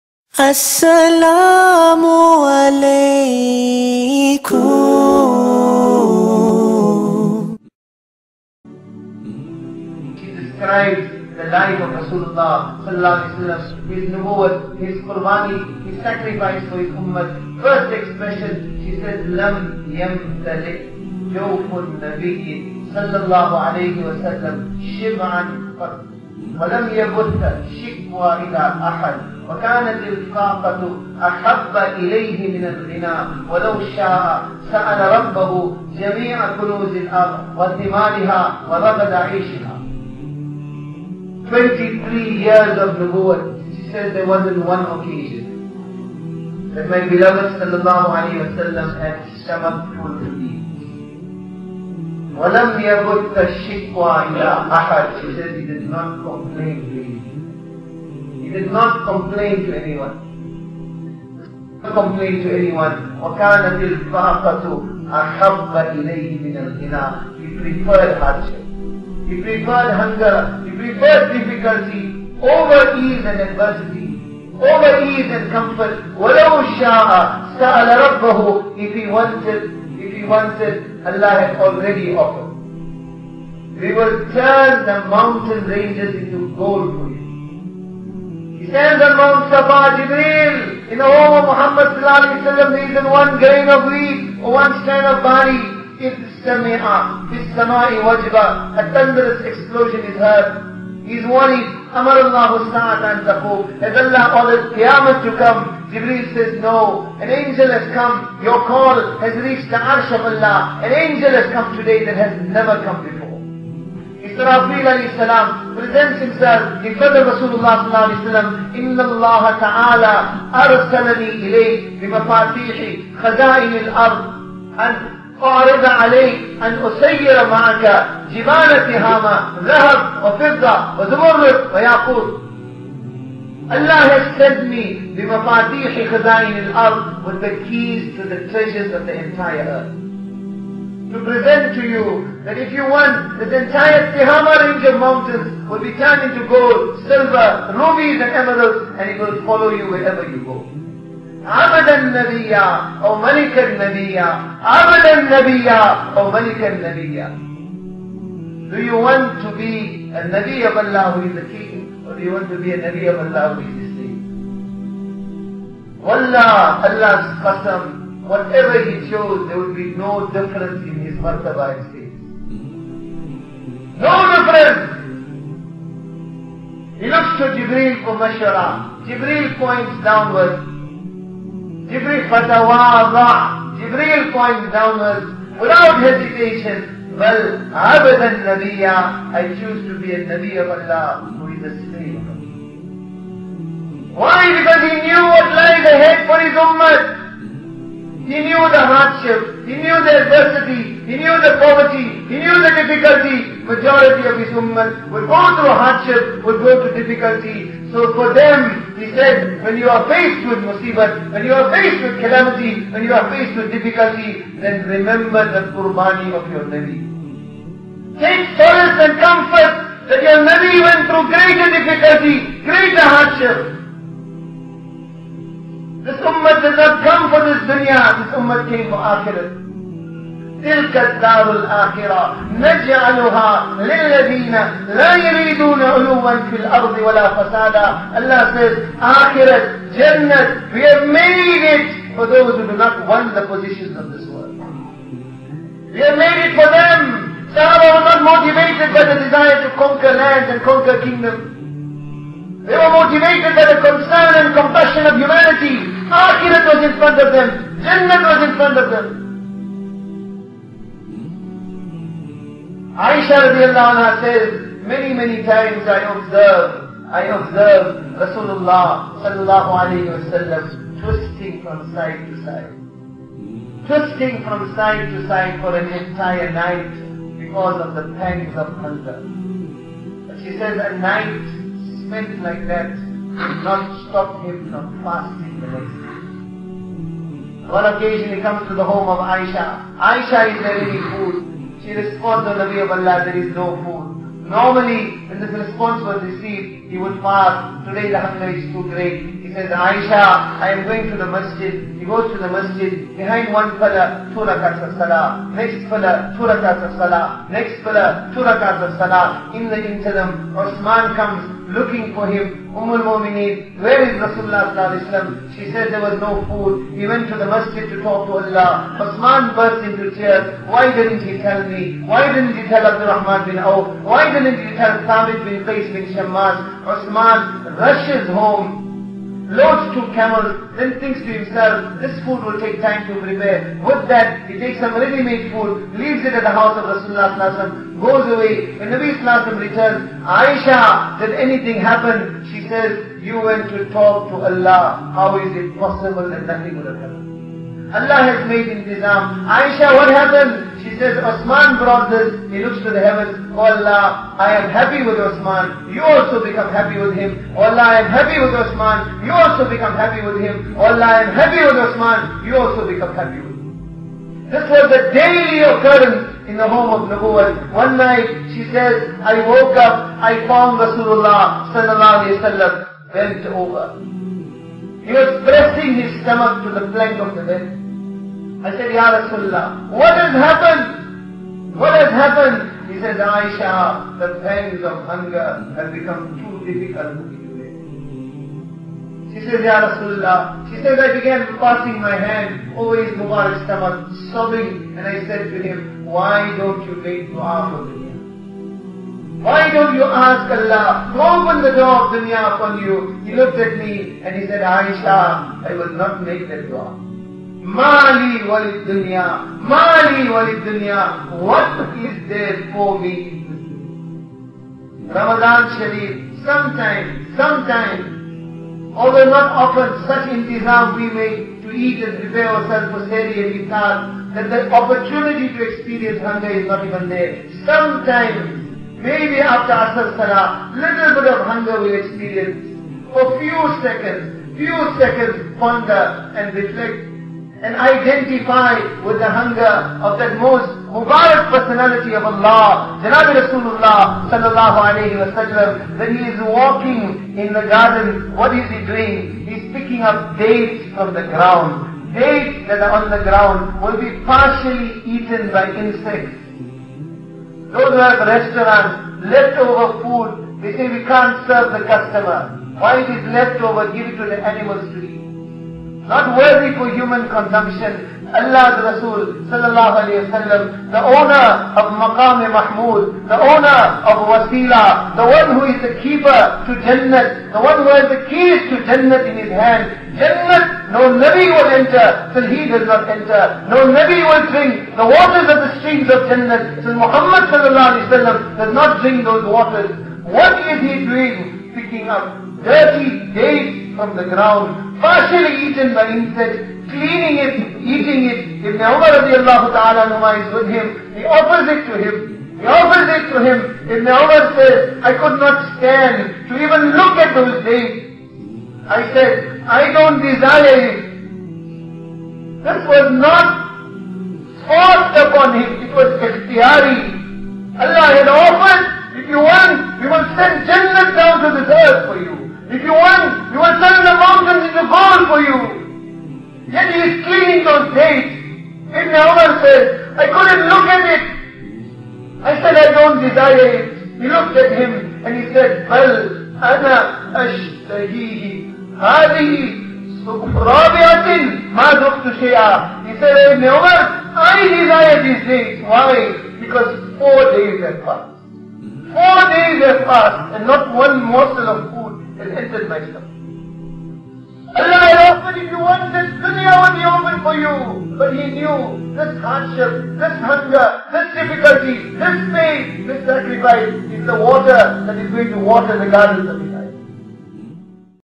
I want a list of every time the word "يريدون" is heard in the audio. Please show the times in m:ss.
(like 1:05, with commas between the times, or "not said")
3:55.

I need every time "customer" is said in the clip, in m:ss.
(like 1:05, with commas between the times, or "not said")
7:41.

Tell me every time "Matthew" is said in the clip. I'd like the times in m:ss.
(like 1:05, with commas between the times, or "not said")
not said.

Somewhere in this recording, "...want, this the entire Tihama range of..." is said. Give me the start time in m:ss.
2:22.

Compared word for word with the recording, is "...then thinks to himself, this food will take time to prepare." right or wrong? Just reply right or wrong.
right.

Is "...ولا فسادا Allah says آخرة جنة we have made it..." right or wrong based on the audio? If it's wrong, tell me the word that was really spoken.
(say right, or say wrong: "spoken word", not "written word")
right.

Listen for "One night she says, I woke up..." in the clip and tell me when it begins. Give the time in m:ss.
6:07.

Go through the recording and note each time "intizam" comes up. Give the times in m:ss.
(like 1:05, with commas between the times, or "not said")
5:48, 7:00.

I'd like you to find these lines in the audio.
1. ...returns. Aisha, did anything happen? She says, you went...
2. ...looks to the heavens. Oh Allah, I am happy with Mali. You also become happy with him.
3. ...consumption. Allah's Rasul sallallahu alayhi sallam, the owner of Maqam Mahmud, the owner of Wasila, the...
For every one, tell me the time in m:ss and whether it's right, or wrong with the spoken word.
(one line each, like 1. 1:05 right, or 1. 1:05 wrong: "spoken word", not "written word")
1. 5:39 right
2. 5:52 wrong: "Osman", not "Mali"
3. 7:47 right.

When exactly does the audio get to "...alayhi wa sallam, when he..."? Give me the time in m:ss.
7:24.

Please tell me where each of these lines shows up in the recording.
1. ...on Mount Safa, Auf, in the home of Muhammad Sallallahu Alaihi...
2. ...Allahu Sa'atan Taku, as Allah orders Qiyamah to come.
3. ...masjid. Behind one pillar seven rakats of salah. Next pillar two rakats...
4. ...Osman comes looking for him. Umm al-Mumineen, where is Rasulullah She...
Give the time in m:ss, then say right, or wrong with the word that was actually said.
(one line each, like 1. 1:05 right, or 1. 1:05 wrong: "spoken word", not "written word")
1. 1:29 wrong: "Jibreel", not "Auf"
2. 1:42 right
3. 5:02 wrong: "two", not "seven"
4. 5:10 right.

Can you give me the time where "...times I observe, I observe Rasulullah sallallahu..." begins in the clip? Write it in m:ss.
4:25.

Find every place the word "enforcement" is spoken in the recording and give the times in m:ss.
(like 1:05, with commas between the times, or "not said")
not said.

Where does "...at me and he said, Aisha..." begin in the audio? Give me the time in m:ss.
6:43.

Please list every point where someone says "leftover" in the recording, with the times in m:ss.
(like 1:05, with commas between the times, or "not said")
7:39, 7:43.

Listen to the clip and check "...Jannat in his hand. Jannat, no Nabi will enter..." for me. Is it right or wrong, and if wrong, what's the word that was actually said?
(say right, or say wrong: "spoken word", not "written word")
right.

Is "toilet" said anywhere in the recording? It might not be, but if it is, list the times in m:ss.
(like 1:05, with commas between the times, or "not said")
not said.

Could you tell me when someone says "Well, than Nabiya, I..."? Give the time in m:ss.
3:07.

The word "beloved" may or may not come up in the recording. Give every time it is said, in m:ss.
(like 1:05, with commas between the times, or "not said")
0:47.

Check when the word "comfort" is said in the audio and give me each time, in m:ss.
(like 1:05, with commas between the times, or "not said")
1:15, 3:39.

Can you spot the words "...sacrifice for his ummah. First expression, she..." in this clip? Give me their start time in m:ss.
0:16.